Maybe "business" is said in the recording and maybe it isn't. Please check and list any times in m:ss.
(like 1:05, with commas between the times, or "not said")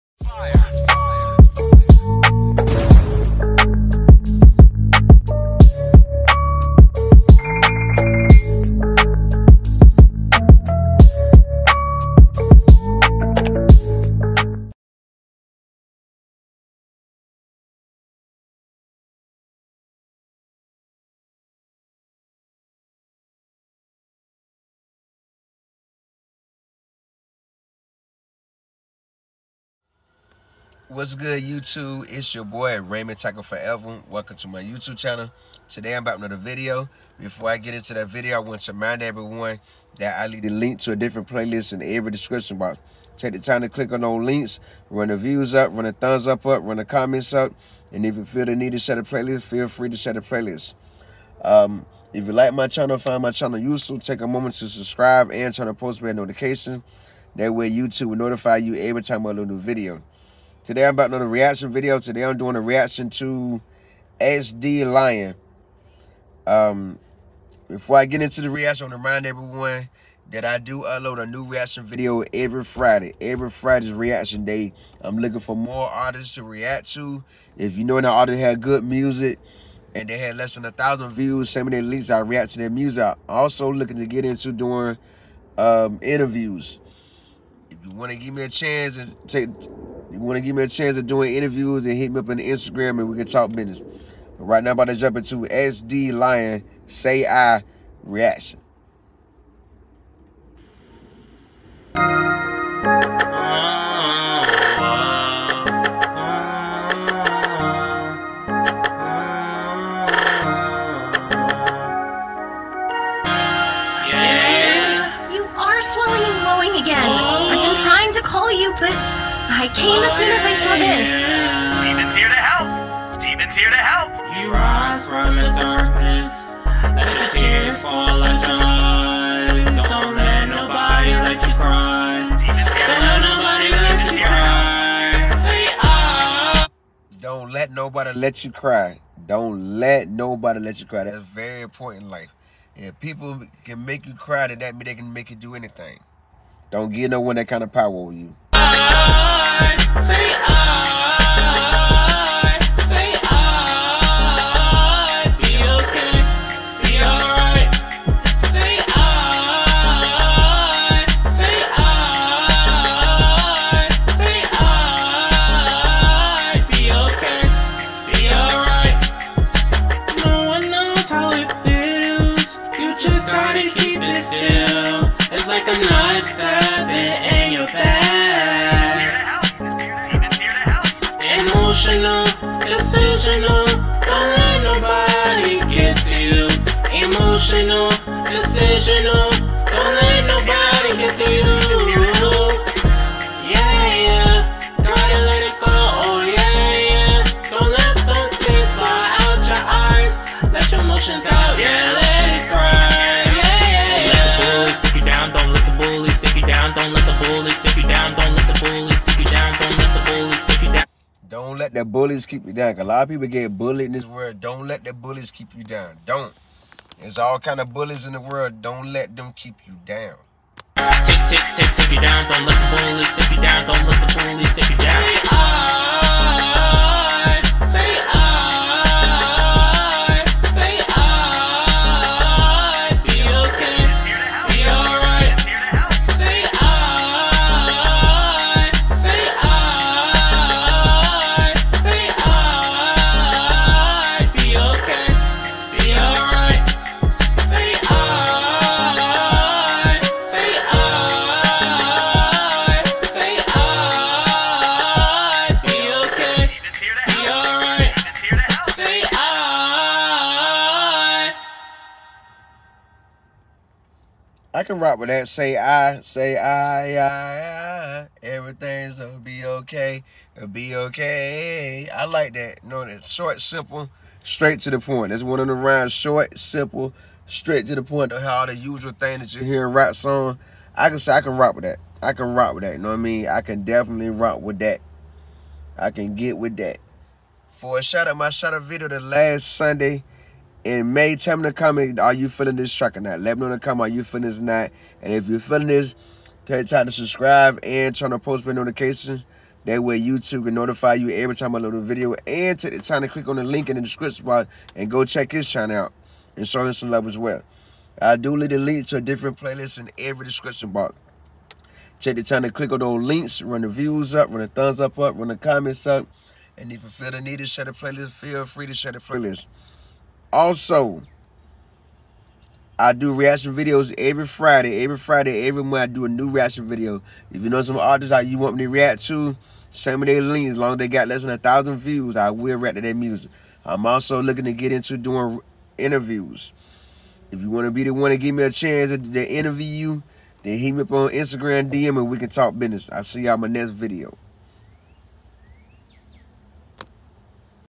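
1:33, 5:42.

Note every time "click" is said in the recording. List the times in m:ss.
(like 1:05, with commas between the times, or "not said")
0:43, 5:03, 5:12.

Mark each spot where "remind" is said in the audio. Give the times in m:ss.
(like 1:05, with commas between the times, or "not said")
0:38, 1:09.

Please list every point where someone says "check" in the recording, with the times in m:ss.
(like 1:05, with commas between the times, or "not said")
5:05.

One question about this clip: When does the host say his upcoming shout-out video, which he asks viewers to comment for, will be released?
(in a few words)
Last Sunday in May.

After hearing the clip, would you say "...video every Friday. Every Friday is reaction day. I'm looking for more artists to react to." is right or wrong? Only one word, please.
right.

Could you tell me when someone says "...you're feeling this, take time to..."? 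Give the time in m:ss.
4:55.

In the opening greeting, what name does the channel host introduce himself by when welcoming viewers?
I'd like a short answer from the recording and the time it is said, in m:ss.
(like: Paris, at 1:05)
Raymond for Forever, at 0:32.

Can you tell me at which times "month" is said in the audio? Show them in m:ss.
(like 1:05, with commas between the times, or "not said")
5:25.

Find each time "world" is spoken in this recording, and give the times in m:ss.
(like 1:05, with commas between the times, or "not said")
3:34, 3:38.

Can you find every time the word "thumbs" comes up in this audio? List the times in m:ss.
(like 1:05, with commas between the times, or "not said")
0:45, 5:14.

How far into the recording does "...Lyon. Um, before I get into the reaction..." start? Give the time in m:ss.
1:04.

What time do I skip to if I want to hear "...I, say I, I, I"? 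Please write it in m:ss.
4:25.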